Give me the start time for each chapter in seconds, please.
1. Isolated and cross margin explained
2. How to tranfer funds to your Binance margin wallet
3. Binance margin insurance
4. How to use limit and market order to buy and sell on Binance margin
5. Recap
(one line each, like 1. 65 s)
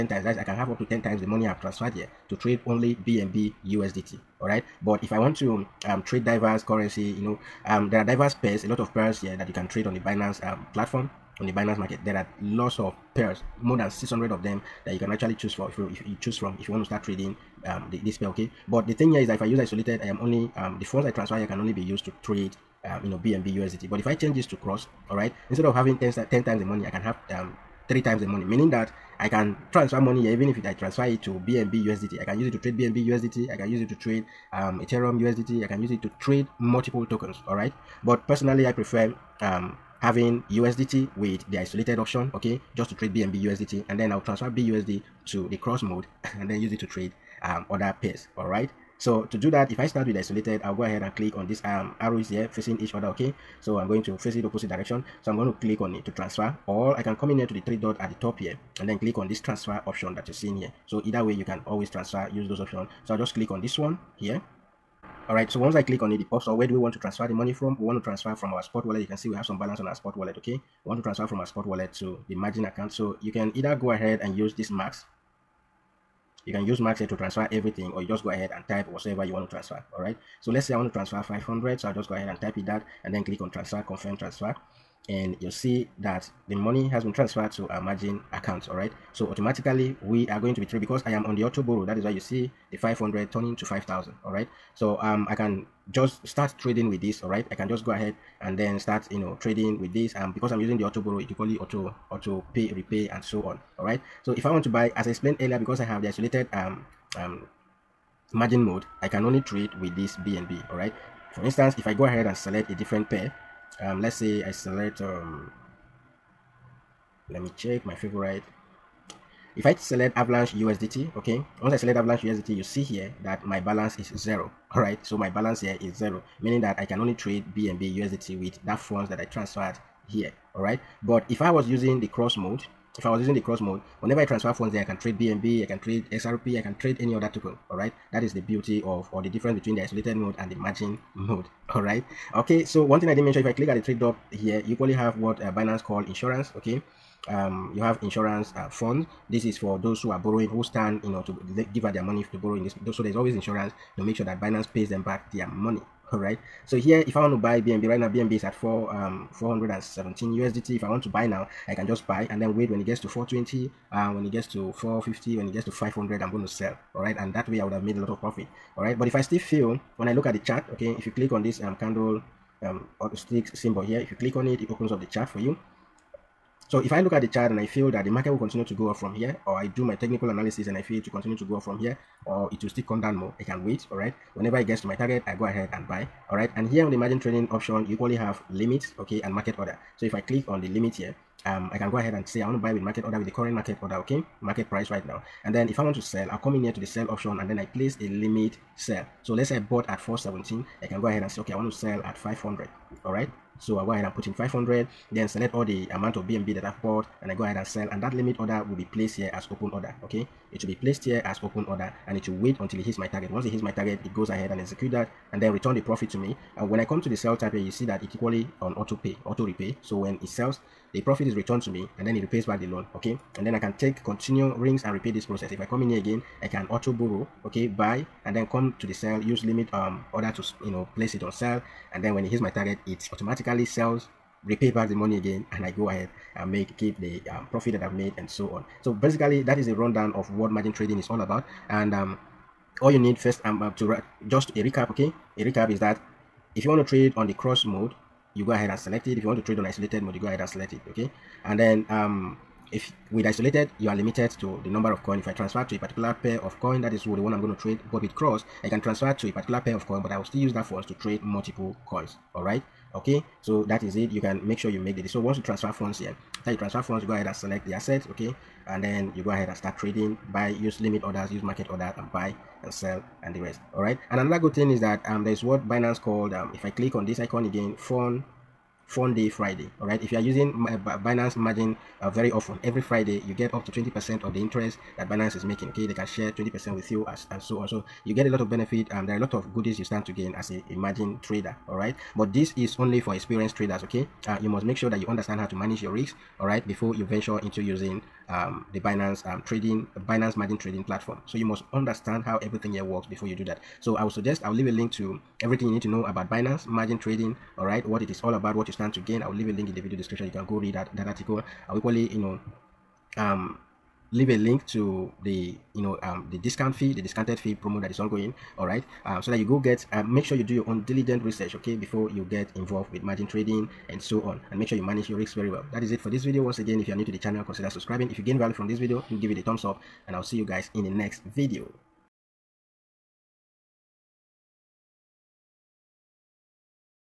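1. 18 s
2. 49 s
3. 143 s
4. 176 s
5. 246 s.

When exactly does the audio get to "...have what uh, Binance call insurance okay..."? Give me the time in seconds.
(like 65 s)
144 s.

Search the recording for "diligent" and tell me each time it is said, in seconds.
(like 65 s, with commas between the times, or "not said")
320 s.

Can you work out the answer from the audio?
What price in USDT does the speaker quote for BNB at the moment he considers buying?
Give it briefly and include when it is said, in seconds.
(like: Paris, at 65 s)
417 USDT, at 159 s.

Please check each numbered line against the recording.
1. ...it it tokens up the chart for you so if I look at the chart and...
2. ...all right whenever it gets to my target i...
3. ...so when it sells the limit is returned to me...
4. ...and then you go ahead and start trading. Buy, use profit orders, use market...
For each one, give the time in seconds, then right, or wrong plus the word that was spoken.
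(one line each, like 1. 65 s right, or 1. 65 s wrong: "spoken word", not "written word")
1. 174 s wrong: "opens", not "tokens"
2. 183 s right
3. 219 s wrong: "profit", not "limit"
4. 268 s wrong: "limit", not "profit".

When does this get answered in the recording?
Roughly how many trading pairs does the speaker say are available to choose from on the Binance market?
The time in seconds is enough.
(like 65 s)
13 s.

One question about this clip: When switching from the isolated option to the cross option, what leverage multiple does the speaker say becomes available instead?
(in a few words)
3 times.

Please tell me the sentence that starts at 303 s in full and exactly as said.
So I will suggest I will leave a link to everything you need to know about Binance margin trading.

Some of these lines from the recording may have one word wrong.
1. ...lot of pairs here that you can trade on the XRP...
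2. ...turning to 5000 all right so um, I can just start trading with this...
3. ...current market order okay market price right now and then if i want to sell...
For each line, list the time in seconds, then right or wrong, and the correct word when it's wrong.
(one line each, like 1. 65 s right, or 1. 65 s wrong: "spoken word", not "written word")
1. 8 s wrong: "Binance", not "XRP"
2. 93 s right
3. 193 s right.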